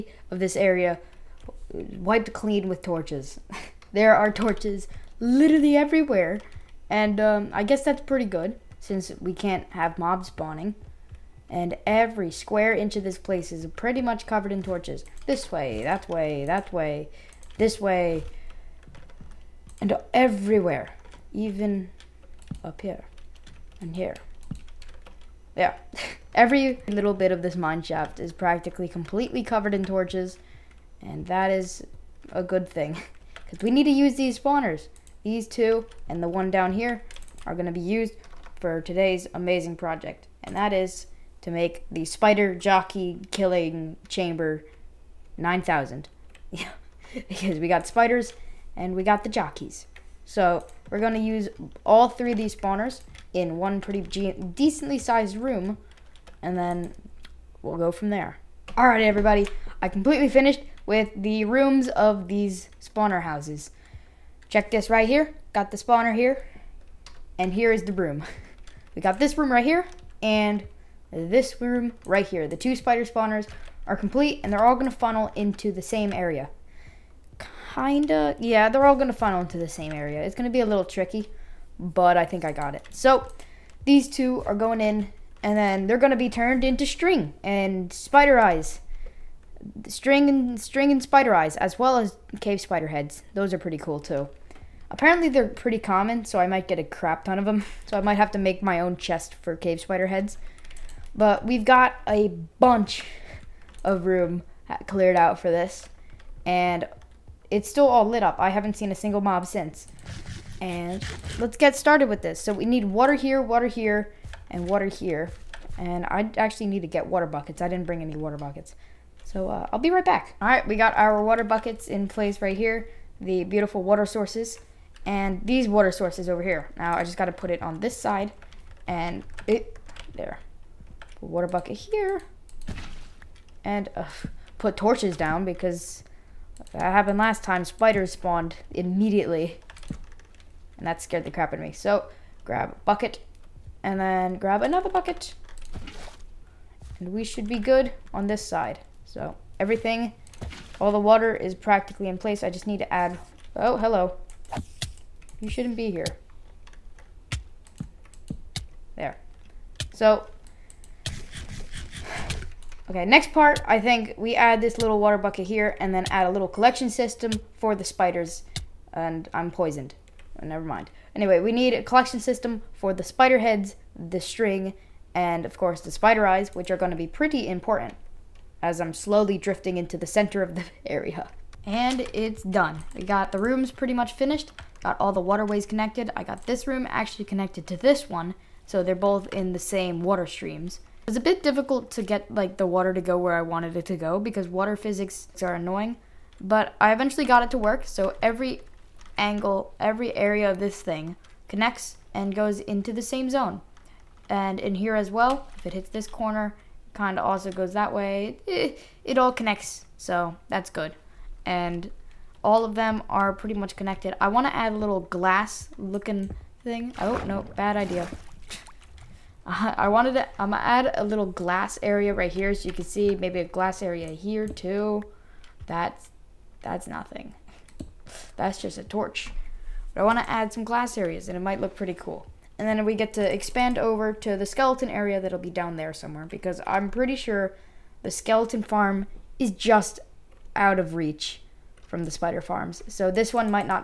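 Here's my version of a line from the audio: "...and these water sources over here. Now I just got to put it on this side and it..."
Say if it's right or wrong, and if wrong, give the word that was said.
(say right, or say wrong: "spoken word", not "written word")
right.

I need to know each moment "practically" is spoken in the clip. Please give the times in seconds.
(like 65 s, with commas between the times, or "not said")
28 s, 151 s.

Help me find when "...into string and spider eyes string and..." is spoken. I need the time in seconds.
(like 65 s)
86 s.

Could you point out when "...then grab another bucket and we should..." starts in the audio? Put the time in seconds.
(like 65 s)
143 s.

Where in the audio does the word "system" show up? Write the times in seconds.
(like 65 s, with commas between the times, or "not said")
166 s, 172 s.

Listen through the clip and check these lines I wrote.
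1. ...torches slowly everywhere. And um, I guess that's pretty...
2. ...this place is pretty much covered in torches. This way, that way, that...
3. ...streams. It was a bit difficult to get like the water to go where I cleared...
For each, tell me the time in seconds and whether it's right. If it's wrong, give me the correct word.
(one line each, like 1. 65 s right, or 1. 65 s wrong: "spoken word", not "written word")
1. 4 s wrong: "literally", not "slowly"
2. 13 s right
3. 190 s wrong: "wanted", not "cleared".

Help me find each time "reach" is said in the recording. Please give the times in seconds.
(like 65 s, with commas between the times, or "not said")
240 s.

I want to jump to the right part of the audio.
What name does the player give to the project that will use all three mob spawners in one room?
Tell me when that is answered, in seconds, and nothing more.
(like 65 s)
42 s.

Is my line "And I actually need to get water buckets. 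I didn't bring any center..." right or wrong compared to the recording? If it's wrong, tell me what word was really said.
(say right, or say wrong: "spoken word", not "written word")
wrong: "water", not "center".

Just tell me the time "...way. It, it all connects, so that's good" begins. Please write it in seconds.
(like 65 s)
207 s.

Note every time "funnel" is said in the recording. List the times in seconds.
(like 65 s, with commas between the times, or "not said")
74 s, 79 s.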